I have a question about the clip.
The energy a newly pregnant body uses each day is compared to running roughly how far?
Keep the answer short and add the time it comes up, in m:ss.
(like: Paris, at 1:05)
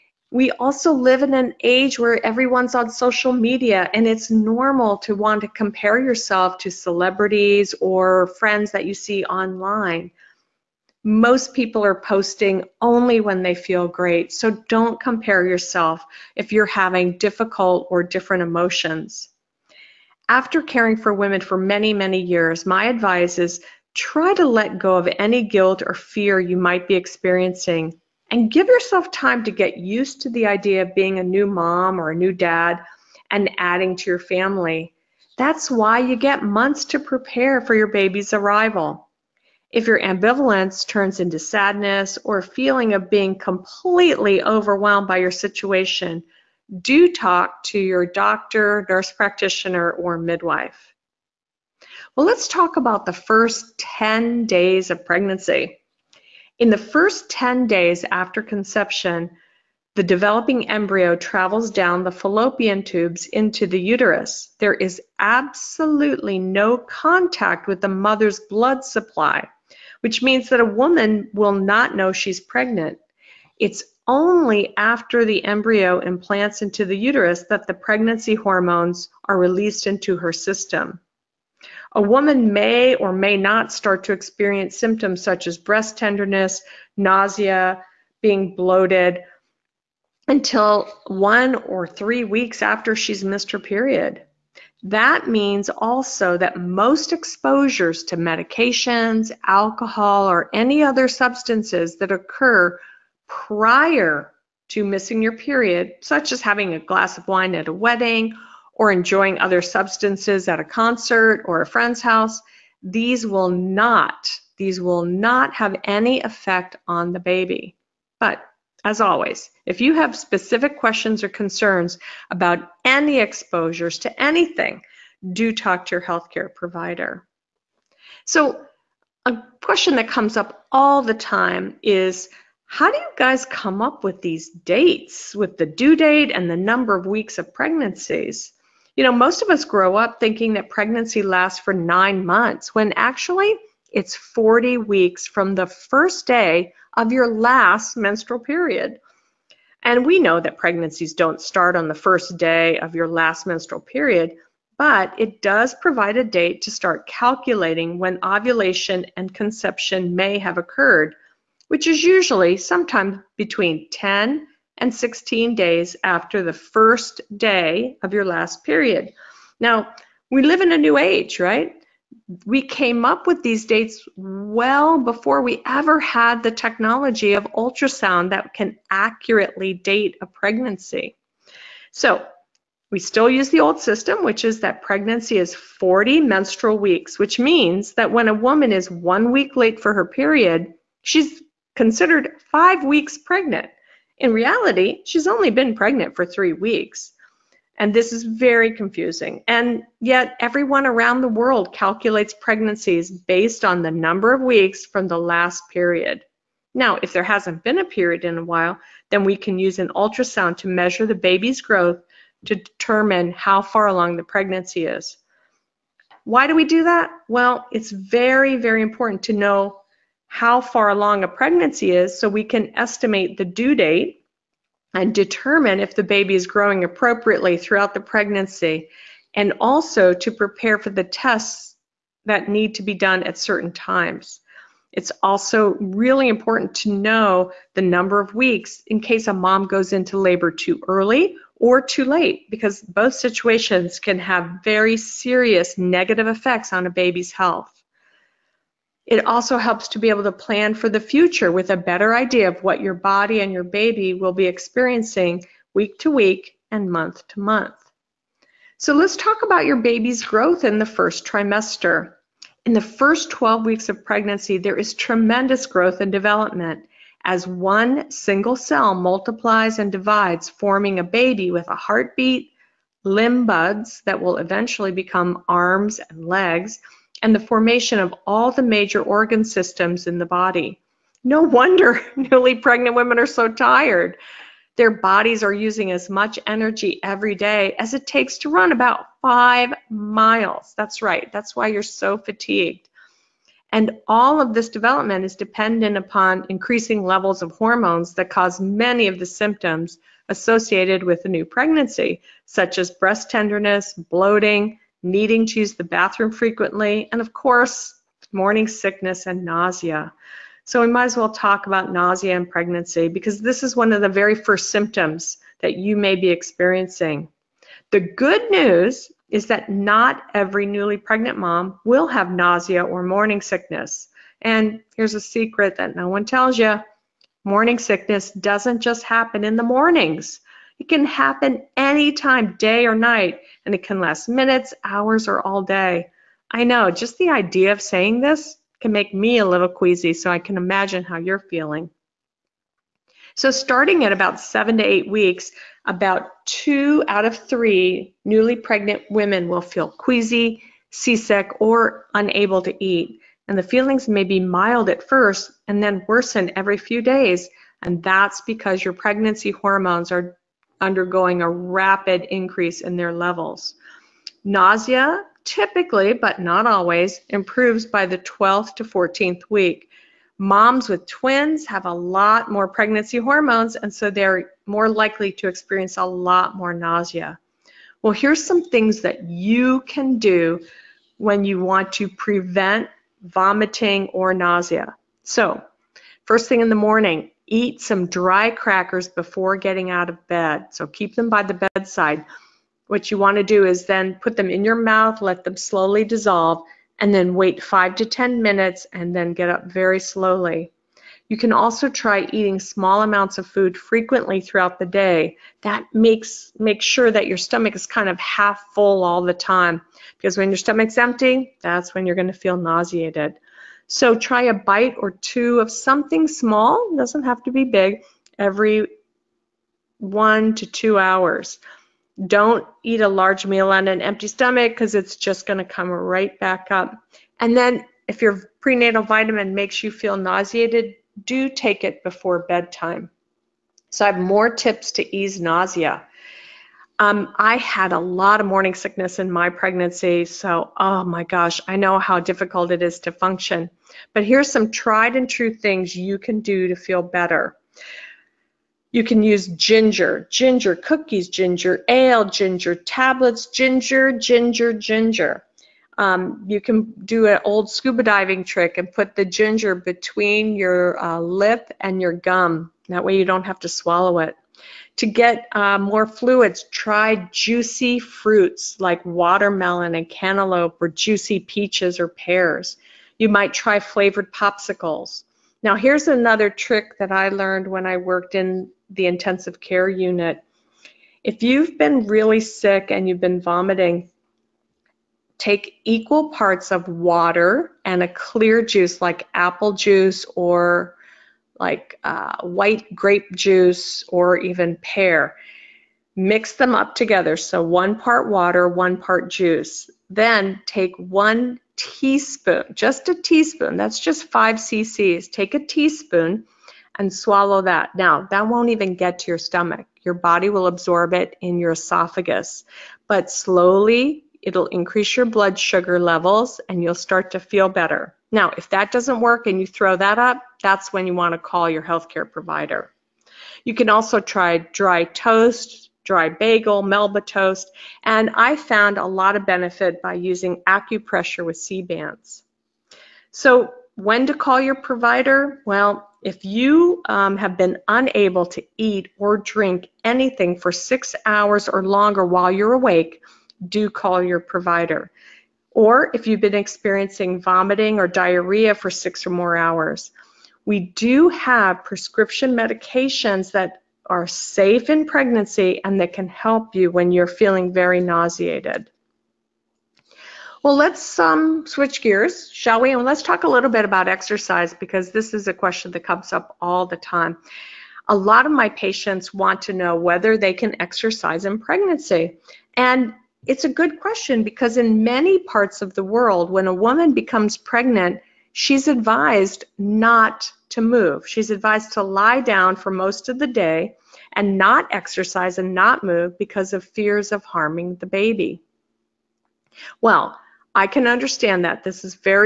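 5 miles, at 4:48.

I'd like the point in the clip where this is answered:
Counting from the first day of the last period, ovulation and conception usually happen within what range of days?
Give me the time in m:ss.
2:43.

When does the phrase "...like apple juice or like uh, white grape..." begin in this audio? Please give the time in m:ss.
8:08.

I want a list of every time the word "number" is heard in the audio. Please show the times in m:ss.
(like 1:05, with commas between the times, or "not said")
2:16, 3:23, 3:57.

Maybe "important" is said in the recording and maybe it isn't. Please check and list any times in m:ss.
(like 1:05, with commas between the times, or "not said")
3:38, 3:56.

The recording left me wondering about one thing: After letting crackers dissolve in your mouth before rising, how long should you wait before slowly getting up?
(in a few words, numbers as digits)
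5 to 10 minutes.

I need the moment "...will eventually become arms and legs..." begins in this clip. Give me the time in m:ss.
4:34.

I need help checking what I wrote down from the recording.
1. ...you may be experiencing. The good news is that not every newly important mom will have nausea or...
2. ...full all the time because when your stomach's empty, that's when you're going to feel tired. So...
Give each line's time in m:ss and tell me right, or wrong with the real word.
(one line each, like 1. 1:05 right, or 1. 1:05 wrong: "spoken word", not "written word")
1. 5:15 wrong: "pregnant", not "important"
2. 6:48 wrong: "nauseated", not "tired".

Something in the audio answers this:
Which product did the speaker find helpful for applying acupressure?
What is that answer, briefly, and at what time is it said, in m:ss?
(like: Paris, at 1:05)
Sea-Bands, at 8:51.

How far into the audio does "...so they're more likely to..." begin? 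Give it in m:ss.
6:13.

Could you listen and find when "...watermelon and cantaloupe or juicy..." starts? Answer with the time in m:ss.
7:49.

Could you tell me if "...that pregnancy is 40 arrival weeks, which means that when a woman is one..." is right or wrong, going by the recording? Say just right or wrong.
wrong.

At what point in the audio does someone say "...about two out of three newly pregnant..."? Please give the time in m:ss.
5:45.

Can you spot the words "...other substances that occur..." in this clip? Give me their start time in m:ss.
1:40.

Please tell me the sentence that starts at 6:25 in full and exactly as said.
So, first thing in the morning, Eat some dry crackers before getting out of bed.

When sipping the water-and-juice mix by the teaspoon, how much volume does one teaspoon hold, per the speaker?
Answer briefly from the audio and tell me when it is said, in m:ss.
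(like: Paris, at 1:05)
5 cc, at 8:24.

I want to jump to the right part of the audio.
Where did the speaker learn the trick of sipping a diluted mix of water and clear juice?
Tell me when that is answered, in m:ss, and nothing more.
7:59.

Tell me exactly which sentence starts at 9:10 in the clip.
We do have prescription medications that are safe in pregnancy and that can help you when you're feeling very nauseated.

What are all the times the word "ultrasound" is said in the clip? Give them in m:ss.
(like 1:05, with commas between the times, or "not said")
2:57, 3:29.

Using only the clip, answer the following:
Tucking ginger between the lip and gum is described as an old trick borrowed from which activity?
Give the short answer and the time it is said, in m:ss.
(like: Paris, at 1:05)
Scuba diving, at 7:37.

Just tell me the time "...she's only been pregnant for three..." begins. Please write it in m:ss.
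3:15.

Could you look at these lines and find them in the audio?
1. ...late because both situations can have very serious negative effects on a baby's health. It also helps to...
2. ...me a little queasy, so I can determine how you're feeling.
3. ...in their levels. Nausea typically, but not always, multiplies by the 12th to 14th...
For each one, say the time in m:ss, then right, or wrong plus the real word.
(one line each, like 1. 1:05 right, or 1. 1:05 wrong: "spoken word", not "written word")
1. 4:02 right
2. 5:39 wrong: "imagine", not "determine"
3. 6:02 wrong: "improves", not "multiplies".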